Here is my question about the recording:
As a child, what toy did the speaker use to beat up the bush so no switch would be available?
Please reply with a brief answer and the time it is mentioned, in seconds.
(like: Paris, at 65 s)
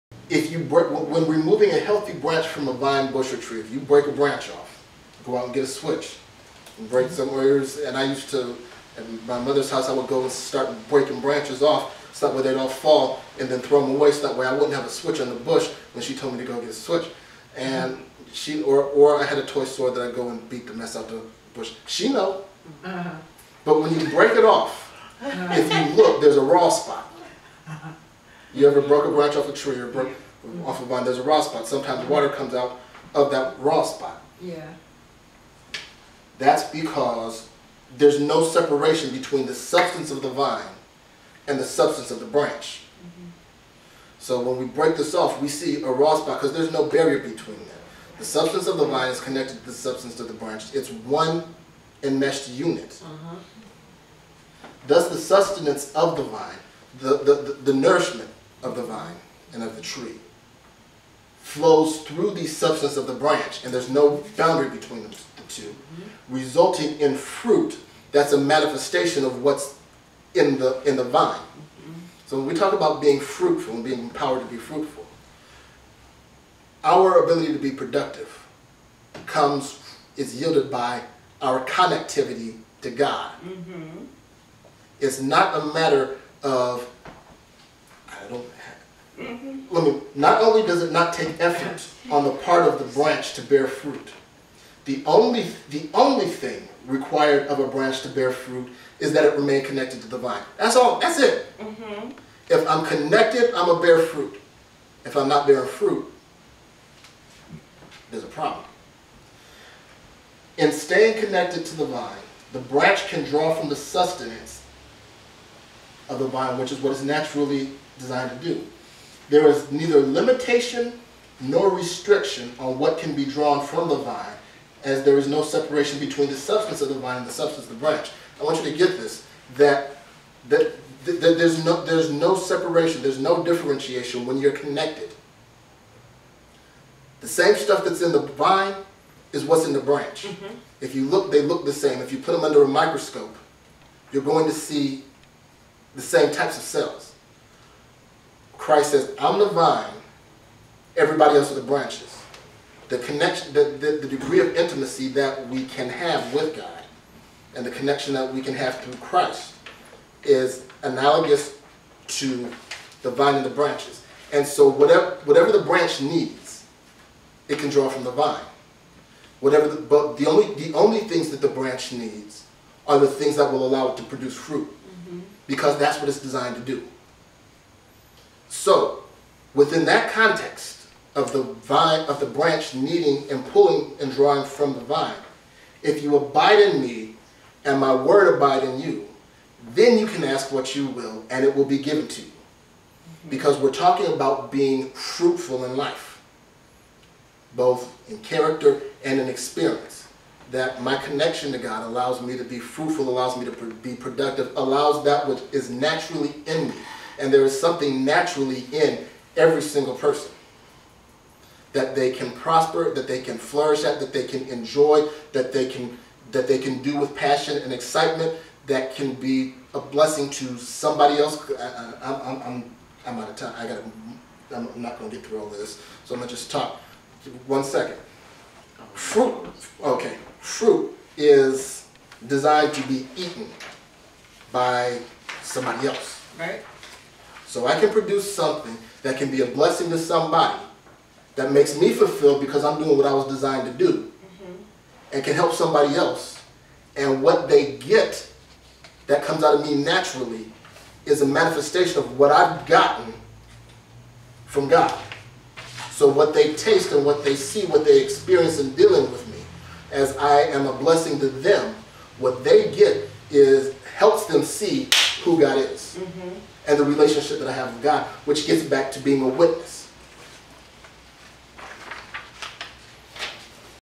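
toy sword, at 19 s.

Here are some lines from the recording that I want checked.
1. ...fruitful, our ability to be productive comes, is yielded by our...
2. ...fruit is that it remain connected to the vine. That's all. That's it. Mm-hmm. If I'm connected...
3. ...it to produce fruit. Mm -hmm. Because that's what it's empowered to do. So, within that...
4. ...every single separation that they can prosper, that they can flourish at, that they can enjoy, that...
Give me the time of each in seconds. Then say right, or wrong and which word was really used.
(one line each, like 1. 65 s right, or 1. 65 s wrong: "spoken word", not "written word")
1. 74 s right
2. 98 s right
3. 173 s wrong: "designed", not "empowered"
4. 209 s wrong: "person", not "separation".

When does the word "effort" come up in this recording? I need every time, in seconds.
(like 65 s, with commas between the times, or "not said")
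91 s.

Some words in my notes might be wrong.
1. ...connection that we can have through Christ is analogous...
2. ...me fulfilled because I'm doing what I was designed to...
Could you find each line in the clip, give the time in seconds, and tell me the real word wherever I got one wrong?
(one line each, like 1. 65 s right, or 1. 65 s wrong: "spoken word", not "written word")
1. 157 s right
2. 241 s right.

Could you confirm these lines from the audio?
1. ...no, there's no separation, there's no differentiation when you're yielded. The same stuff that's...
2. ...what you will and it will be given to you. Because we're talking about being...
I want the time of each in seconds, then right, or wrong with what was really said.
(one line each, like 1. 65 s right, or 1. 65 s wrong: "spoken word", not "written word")
1. 131 s wrong: "connected", not "yielded"
2. 190 s right.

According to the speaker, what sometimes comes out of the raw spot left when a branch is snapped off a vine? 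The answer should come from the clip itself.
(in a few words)
water.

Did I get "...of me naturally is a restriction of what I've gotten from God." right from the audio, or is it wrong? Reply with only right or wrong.
wrong.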